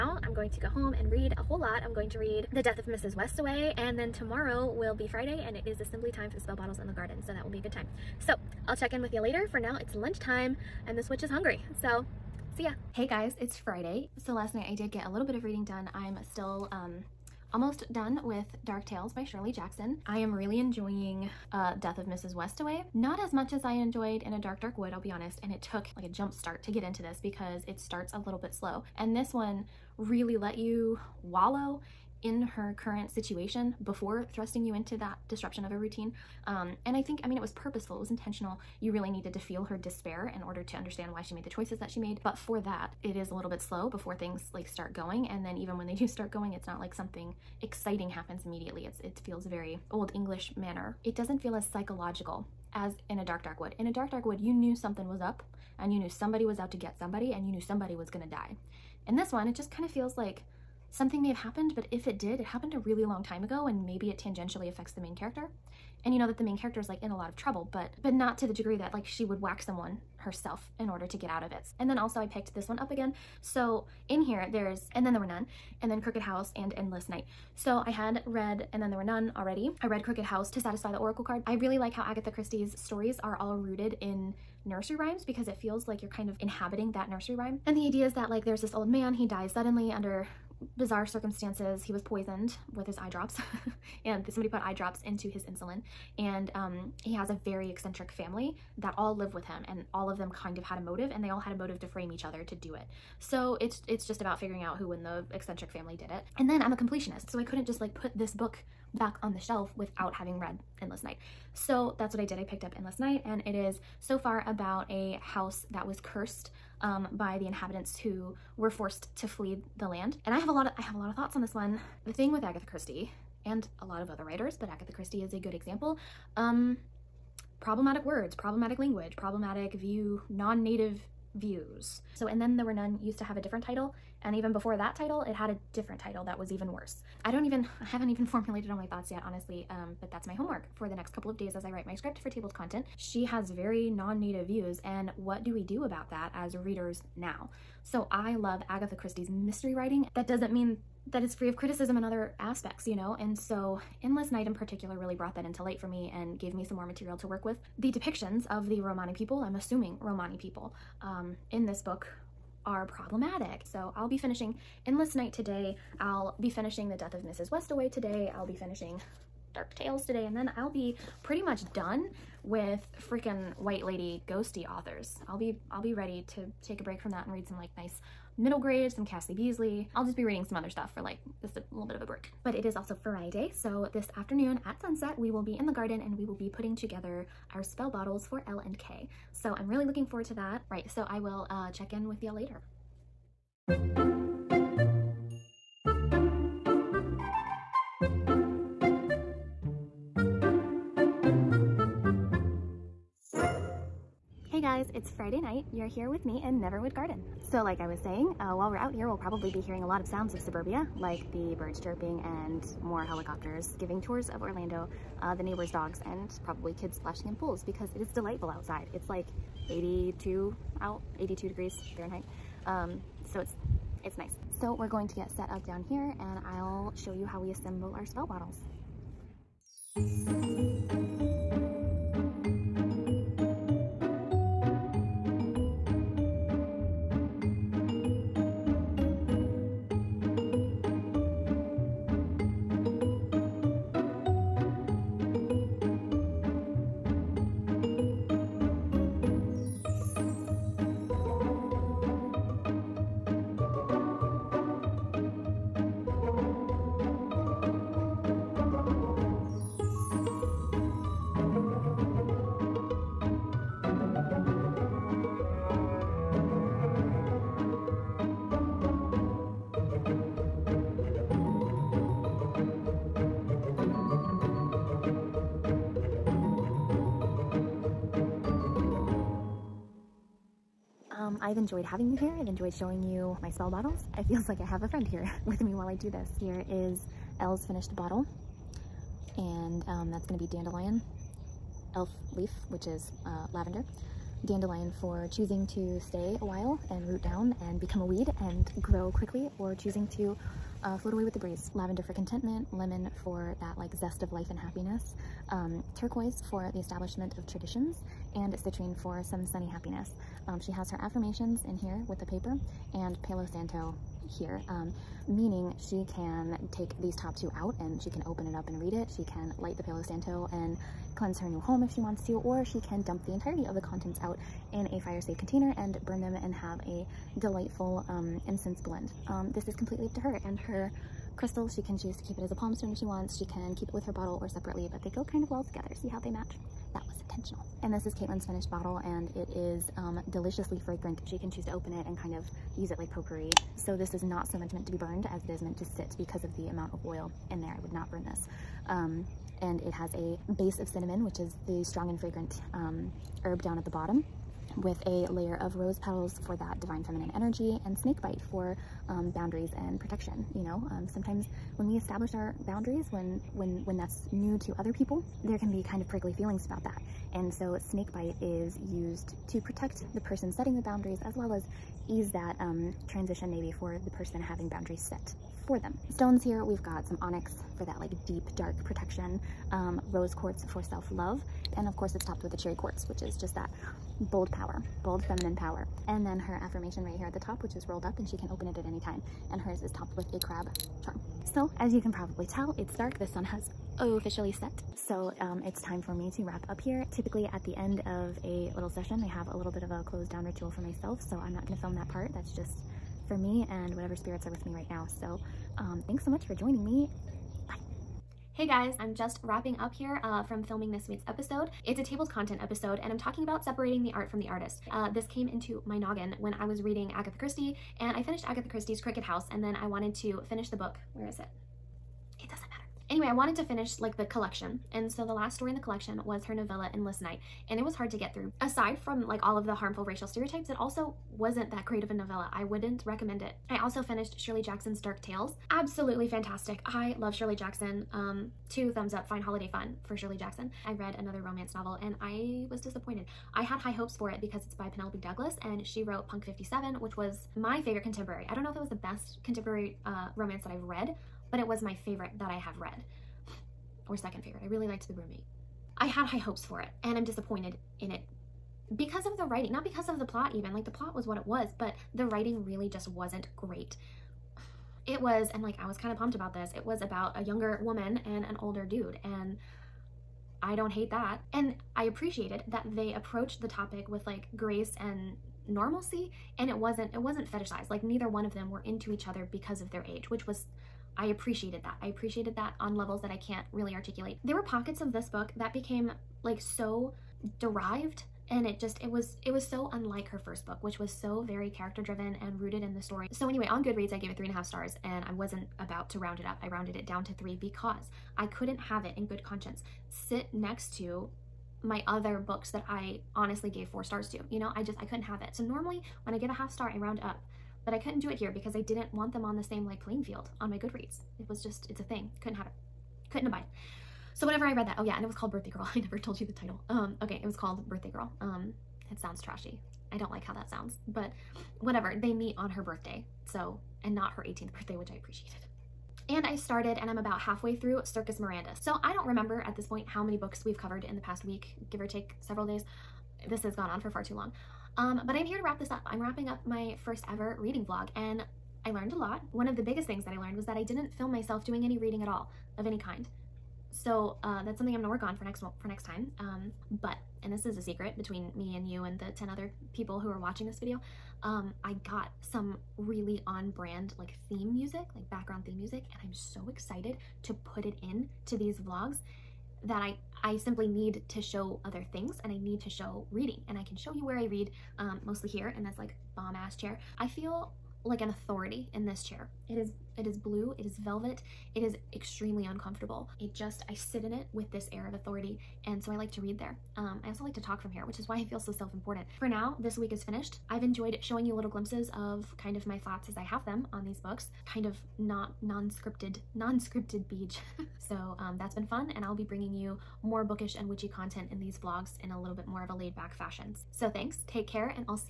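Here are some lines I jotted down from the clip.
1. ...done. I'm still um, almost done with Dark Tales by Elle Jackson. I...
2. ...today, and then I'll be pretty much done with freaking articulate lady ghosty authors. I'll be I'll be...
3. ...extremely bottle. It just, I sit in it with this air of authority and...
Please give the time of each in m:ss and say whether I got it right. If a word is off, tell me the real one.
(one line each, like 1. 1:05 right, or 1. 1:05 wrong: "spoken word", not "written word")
1. 0:15 wrong: "Shirley", not "Elle"
2. 2:50 wrong: "white", not "articulate"
3. 9:32 wrong: "uncomfortable", not "bottle".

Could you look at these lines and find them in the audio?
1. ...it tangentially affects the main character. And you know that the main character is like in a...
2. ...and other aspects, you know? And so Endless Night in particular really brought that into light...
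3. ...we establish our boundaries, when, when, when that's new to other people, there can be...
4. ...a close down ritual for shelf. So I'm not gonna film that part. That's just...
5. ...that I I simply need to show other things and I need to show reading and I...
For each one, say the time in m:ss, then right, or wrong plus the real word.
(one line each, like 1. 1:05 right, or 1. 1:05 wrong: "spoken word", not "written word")
1. 1:04 right
2. 2:31 right
3. 6:01 right
4. 6:39 wrong: "myself", not "shelf"
5. 9:19 right.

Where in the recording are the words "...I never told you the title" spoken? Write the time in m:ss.
8:35.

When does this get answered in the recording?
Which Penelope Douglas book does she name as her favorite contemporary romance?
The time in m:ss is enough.
7:26.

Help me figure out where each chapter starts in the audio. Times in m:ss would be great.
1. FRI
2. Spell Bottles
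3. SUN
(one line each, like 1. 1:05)
1. 0:12
2. 3:13
3. 6:47.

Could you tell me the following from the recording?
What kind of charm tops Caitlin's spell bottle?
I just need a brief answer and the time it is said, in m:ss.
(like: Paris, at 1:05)
Crab charm, at 6:30.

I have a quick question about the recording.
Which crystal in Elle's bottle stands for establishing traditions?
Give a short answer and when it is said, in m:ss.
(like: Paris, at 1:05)
Turquoise, at 5:05.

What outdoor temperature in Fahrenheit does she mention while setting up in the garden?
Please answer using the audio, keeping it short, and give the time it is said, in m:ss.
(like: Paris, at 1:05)
82, at 3:41.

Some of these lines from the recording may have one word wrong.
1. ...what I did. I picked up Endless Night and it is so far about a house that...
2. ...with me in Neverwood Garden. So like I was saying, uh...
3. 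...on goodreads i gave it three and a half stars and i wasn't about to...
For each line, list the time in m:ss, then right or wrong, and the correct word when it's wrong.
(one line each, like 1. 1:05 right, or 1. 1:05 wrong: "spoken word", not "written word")
1. 1:52 right
2. 3:26 right
3. 8:13 right.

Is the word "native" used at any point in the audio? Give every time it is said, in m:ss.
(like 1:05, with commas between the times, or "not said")
2:10, 2:23.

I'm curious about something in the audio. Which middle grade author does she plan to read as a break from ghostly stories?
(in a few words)
Cassie Beasley.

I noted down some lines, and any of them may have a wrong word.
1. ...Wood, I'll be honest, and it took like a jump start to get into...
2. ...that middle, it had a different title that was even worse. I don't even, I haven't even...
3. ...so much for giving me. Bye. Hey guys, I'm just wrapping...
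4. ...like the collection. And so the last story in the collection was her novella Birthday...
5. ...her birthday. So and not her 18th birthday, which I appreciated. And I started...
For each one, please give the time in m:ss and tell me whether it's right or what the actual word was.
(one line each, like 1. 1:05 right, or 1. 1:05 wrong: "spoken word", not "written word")
1. 0:24 right
2. 2:14 wrong: "title", not "middle"
3. 6:46 wrong: "joining", not "giving"
4. 7:03 wrong: "Endless", not "Birthday"
5. 8:42 right.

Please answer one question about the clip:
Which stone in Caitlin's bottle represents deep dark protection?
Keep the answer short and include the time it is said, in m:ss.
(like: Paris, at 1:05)
Onyx, at 6:17.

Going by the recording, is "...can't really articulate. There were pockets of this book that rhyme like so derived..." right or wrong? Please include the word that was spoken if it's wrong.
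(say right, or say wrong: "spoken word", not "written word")
wrong: "became", not "rhyme".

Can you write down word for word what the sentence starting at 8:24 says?
You know, I just, I couldn't have it.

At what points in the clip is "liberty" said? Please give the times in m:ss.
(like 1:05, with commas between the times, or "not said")
not said.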